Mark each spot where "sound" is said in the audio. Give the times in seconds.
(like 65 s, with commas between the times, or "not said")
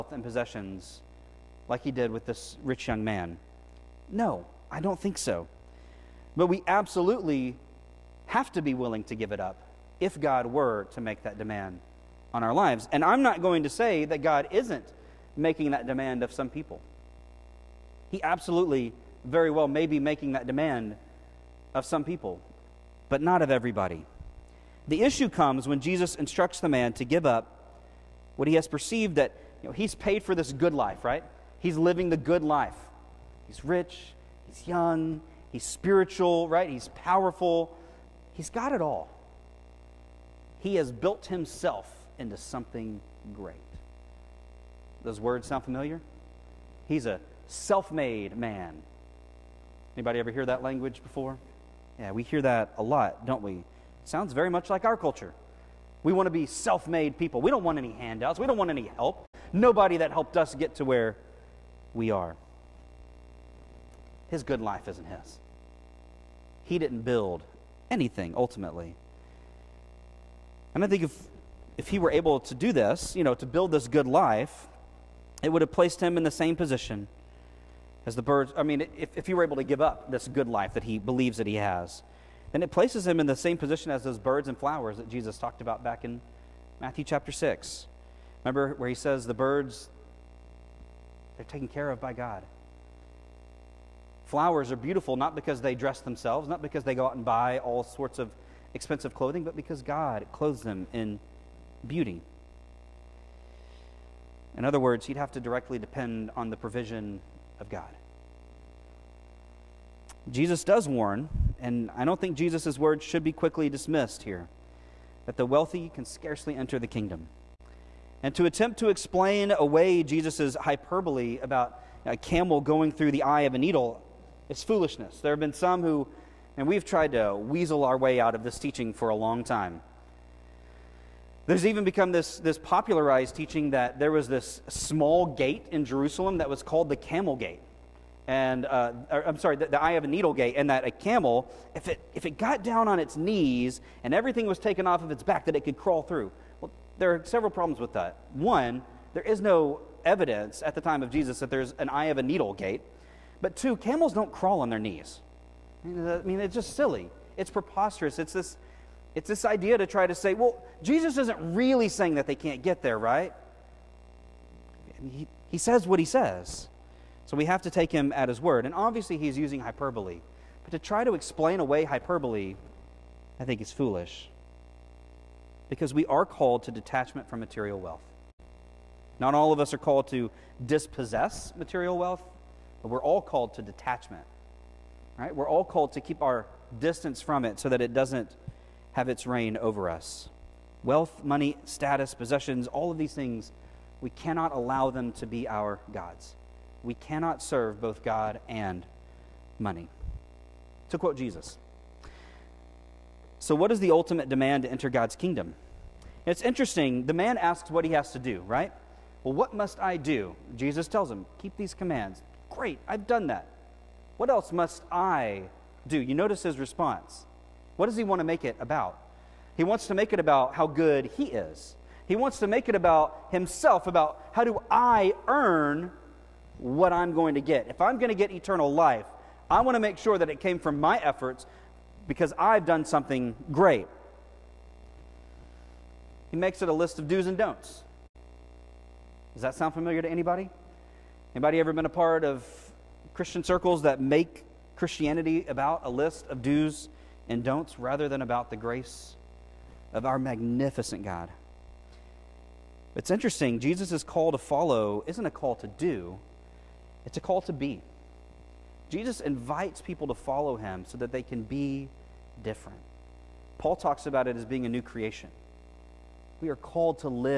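45 s, 54 s, 239 s.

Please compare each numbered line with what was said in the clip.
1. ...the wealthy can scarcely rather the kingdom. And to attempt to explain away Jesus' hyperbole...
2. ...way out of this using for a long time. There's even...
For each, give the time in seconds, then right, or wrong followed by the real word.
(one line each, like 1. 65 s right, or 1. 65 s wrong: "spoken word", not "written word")
1. 115 s wrong: "enter", not "rather"
2. 127 s wrong: "teaching", not "using".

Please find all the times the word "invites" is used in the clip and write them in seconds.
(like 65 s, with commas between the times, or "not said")
259 s.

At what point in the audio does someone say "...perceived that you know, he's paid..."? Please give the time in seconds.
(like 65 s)
28 s.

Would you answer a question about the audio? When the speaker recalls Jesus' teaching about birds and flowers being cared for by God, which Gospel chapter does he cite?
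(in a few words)
Matthew chapter 6.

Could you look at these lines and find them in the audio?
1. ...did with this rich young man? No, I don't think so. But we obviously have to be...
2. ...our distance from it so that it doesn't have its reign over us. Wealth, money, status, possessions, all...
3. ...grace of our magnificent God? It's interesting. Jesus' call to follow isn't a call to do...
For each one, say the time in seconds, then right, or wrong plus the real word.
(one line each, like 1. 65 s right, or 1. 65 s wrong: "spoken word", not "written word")
1. 1 s wrong: "absolutely", not "obviously"
2. 186 s right
3. 248 s right.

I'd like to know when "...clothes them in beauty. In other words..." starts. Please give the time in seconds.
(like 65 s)
100 s.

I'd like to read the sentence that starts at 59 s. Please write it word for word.
Nobody that helped us get to where we are.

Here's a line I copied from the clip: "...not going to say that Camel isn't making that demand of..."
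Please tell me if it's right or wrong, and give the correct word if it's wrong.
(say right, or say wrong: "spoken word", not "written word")
wrong: "God", not "Camel".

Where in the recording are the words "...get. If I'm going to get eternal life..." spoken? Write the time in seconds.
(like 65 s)
227 s.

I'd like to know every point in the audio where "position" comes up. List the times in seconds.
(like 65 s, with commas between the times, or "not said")
76 s, 83 s.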